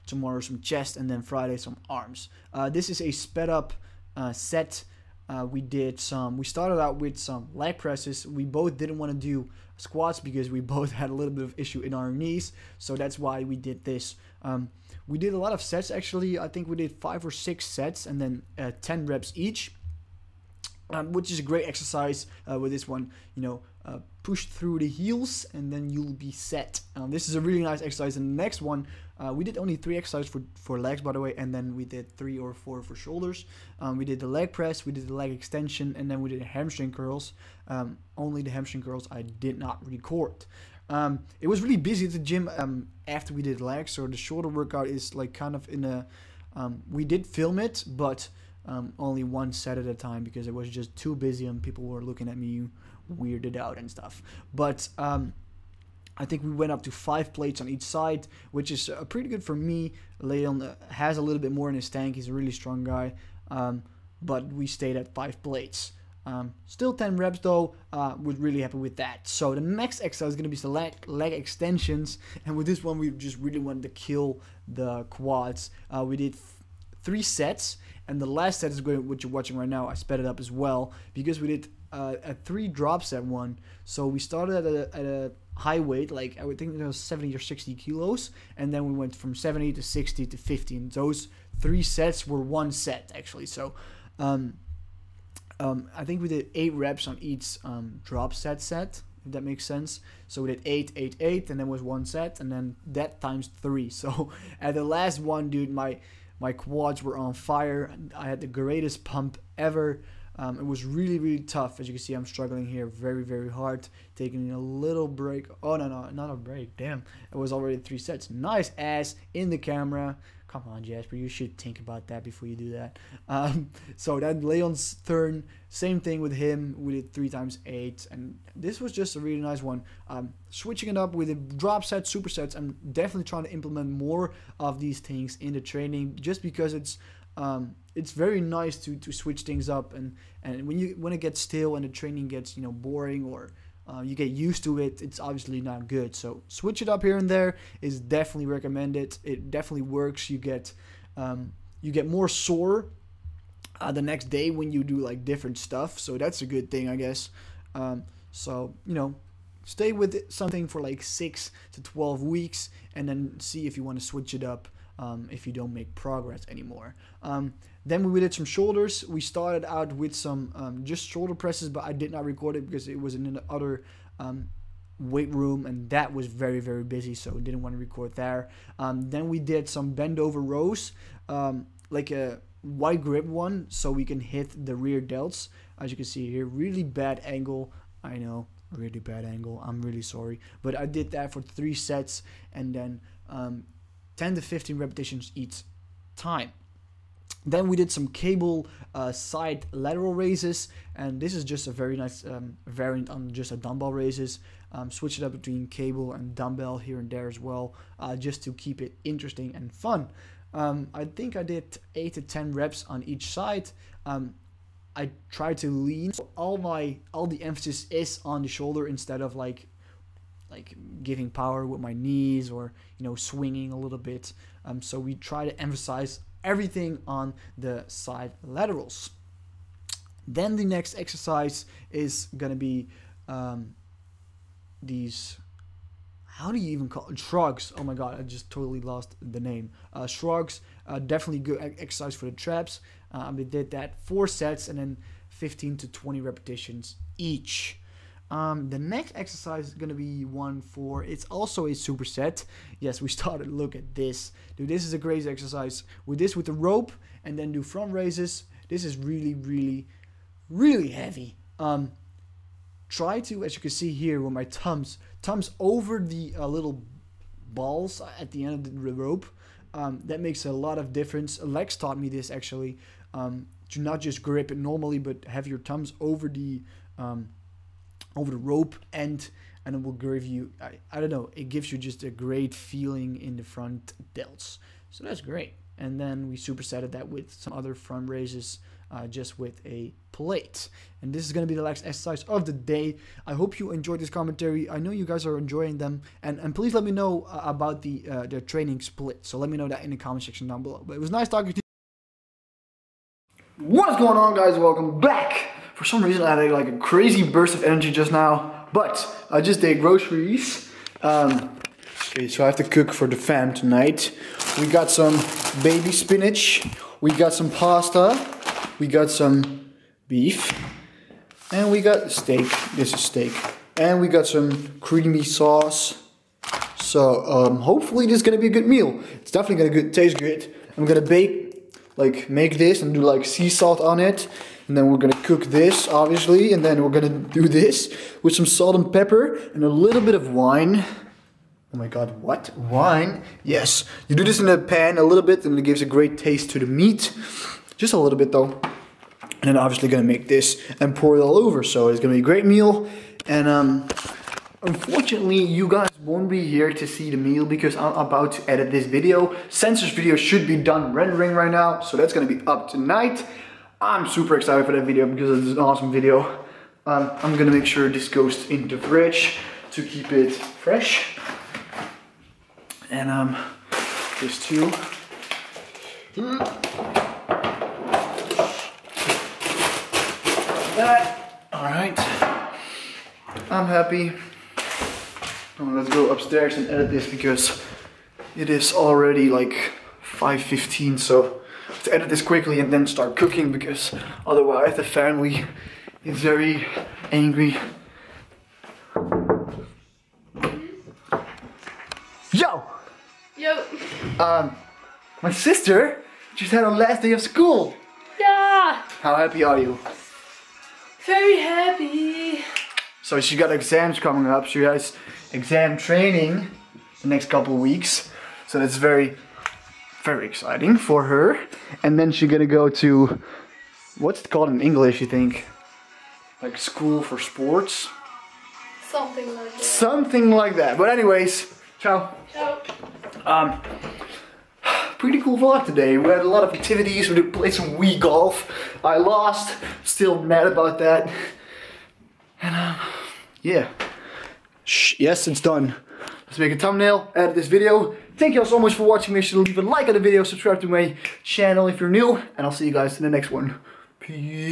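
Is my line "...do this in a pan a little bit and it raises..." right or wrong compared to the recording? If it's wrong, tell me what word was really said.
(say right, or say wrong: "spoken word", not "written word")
wrong: "gives", not "raises".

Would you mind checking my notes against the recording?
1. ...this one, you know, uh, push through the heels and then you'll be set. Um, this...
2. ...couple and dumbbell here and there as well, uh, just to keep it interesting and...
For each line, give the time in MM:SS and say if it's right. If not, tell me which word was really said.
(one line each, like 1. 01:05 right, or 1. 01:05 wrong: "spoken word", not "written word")
1. 00:22 right
2. 03:25 wrong: "cable", not "couple".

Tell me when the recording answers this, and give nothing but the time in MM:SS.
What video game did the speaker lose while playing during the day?
07:17.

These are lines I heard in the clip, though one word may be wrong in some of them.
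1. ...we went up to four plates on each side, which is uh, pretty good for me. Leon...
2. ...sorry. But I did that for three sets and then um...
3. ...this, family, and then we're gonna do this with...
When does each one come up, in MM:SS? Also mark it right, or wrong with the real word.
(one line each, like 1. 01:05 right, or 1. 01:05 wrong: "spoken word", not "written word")
1. 00:56 wrong: "five", not "four"
2. 03:10 right
3. 05:35 wrong: "obviously", not "family".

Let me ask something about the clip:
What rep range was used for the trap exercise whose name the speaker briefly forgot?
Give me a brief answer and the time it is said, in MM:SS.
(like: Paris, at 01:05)
15 to 20, at 04:05.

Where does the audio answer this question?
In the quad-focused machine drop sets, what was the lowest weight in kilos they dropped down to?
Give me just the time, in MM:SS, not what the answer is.
01:30.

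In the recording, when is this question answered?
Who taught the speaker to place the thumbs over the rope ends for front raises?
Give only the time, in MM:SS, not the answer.
04:31.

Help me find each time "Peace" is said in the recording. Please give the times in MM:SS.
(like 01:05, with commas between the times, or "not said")
07:33.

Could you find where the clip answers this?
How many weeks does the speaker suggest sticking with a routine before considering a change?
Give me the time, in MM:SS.
02:41.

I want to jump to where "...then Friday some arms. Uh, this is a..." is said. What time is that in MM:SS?
00:01.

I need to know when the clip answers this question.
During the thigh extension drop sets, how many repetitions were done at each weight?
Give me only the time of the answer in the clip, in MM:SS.
01:36.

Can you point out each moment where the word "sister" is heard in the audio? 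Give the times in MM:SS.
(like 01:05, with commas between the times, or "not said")
06:45.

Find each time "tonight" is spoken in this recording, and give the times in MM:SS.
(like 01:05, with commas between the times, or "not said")
05:13, 06:02.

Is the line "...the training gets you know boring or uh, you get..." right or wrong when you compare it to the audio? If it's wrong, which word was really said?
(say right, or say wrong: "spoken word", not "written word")
right.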